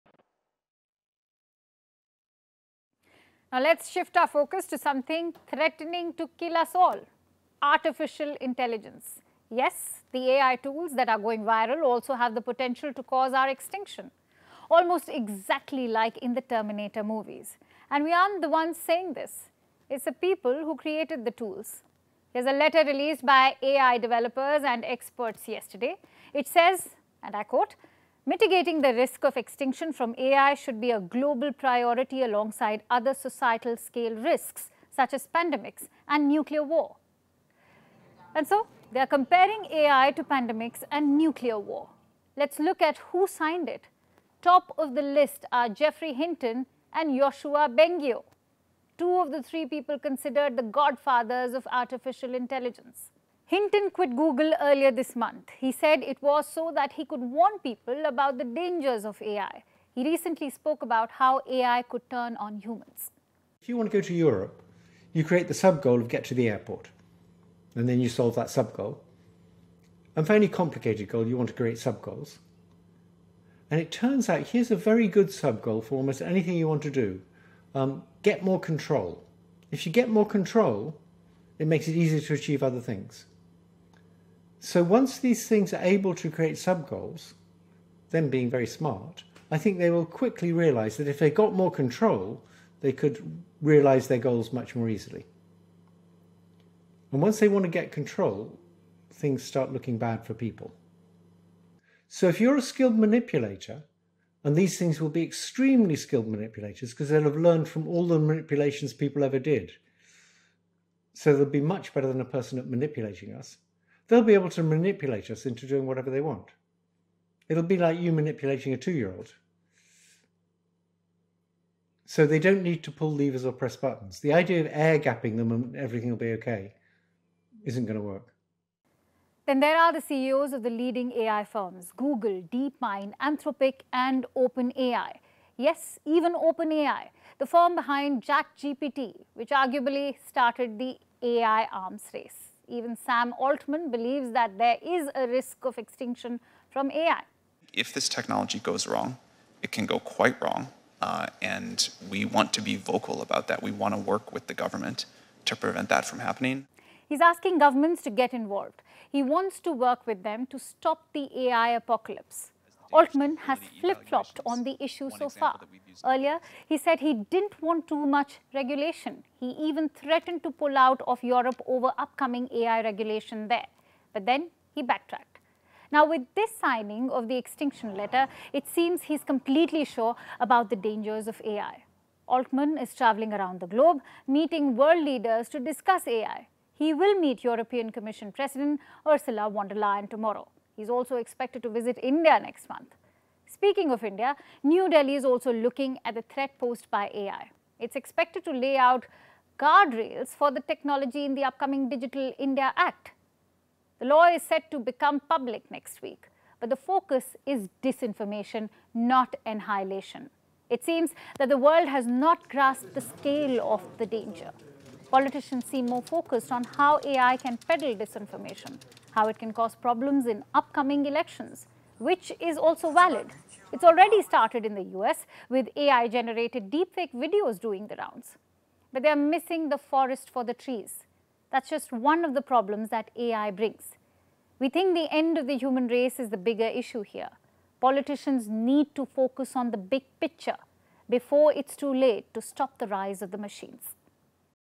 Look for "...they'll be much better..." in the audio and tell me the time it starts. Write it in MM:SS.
01:51.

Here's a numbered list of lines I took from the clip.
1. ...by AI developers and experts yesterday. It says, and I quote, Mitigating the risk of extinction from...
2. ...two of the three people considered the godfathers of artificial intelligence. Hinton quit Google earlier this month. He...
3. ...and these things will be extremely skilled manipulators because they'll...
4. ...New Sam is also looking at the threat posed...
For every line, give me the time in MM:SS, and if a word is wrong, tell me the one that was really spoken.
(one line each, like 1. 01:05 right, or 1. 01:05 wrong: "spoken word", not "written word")
1. 00:23 right
2. 00:48 right
3. 01:44 right
4. 03:14 wrong: "Delhi", not "Sam".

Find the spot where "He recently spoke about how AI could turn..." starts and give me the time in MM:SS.
00:59.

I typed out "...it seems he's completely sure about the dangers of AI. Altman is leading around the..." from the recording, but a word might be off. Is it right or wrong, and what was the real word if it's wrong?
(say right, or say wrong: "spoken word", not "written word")
wrong: "traveling", not "leading".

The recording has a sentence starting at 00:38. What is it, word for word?
And so they are comparing AI to pandemics and nuclear war.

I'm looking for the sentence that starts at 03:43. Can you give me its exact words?
It's already started in the US with AI-generated deepfake videos doing the rounds.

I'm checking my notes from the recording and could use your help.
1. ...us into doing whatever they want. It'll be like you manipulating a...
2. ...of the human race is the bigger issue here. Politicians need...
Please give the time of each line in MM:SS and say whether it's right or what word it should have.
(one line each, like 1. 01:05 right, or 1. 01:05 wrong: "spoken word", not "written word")
1. 01:55 right
2. 03:55 right.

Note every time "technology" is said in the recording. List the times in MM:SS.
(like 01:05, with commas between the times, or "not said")
02:28, 03:20.